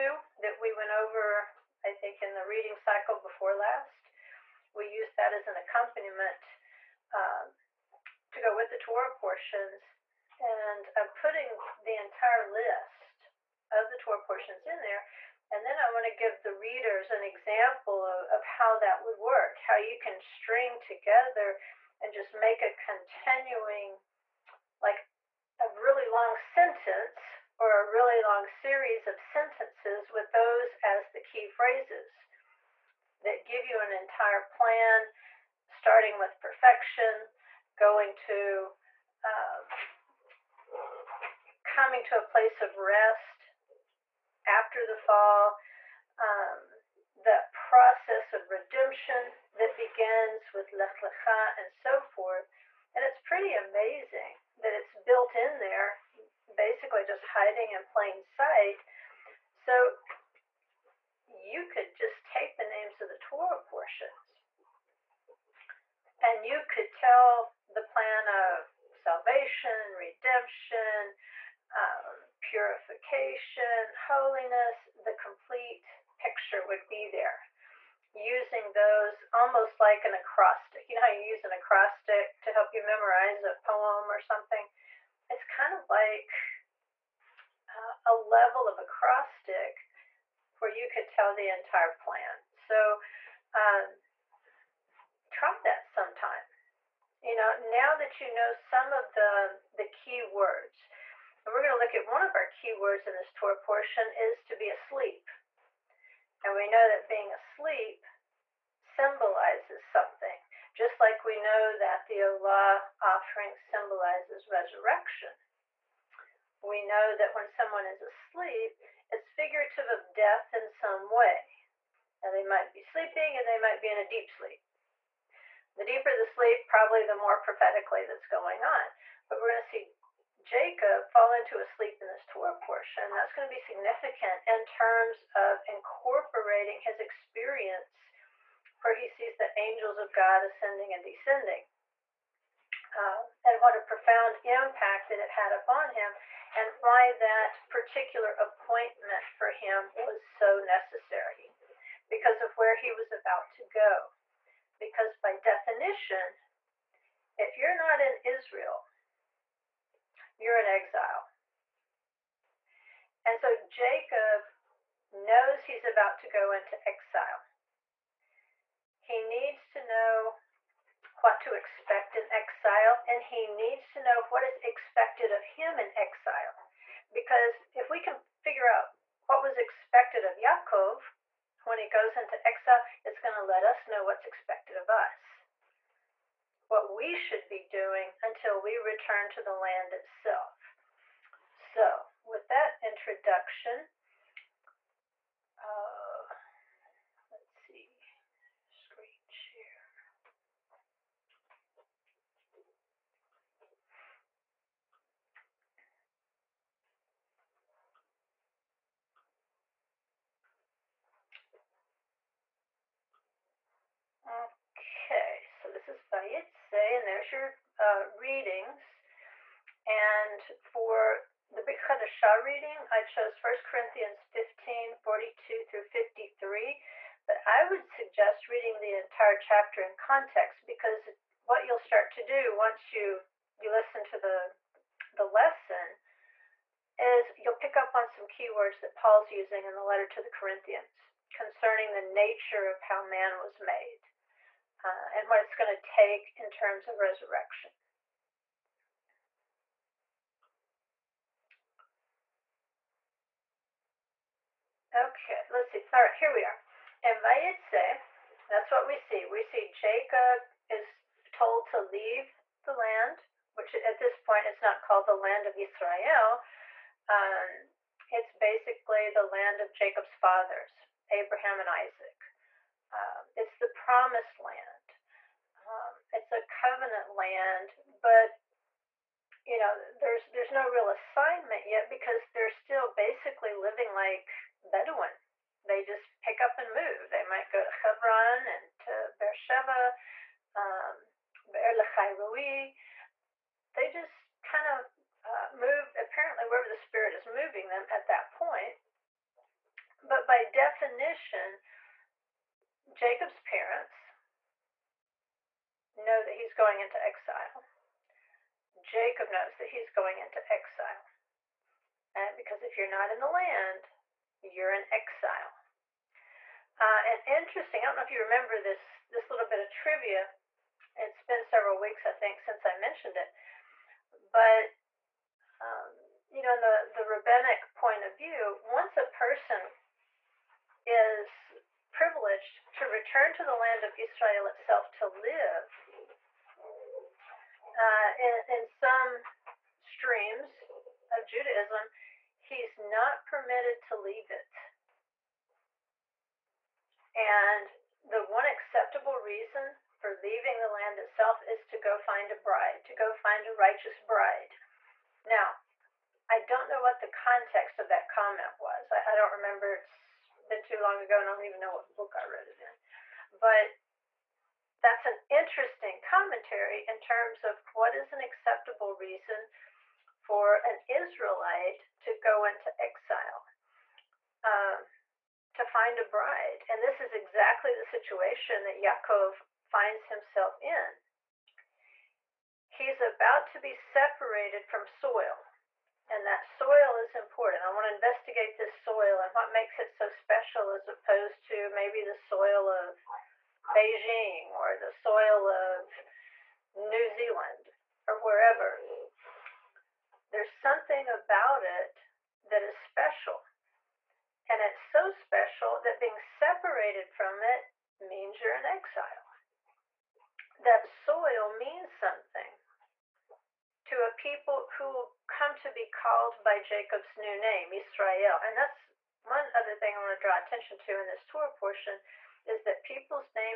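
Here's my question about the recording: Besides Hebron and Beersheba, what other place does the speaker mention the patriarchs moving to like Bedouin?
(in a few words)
Be'er Lahai Roi.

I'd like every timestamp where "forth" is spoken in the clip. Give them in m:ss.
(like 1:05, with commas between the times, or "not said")
0:52.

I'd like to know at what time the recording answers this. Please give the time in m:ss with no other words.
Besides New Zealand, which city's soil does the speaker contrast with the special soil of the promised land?
6:33.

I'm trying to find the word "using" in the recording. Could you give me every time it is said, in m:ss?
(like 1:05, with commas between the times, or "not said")
1:18, 3:59.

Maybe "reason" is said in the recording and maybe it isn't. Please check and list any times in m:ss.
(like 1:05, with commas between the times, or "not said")
5:49, 6:08.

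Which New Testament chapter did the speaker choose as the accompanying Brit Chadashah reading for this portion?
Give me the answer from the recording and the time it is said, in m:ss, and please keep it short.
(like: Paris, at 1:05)
1 Corinthians 15, at 3:43.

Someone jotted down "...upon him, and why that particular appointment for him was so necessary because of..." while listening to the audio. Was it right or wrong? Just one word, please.
right.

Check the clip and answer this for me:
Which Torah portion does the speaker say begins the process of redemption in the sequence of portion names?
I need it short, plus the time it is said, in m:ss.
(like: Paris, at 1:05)
Lech Lecha, at 0:50.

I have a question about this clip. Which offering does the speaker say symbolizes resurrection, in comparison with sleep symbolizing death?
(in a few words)
olah offering.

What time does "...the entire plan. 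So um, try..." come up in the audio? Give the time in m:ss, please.
1:31.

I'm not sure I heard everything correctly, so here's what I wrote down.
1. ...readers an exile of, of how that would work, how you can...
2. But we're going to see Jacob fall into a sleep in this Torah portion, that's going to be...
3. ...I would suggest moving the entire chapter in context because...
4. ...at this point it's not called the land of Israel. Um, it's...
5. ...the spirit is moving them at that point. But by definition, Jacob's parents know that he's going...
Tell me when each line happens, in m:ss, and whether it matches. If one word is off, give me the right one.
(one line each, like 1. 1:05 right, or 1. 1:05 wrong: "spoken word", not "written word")
1. 0:16 wrong: "example", not "exile"
2. 2:09 right
3. 3:47 wrong: "reading", not "moving"
4. 4:23 right
5. 4:56 right.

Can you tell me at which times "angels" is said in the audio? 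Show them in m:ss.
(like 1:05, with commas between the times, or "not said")
2:19.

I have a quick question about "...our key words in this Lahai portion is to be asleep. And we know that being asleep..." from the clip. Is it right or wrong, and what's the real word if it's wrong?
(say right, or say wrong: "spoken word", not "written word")
wrong: "Torah", not "Lahai".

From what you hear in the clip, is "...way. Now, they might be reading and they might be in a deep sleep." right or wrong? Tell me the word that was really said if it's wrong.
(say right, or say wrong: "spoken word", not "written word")
wrong: "sleeping", not "reading".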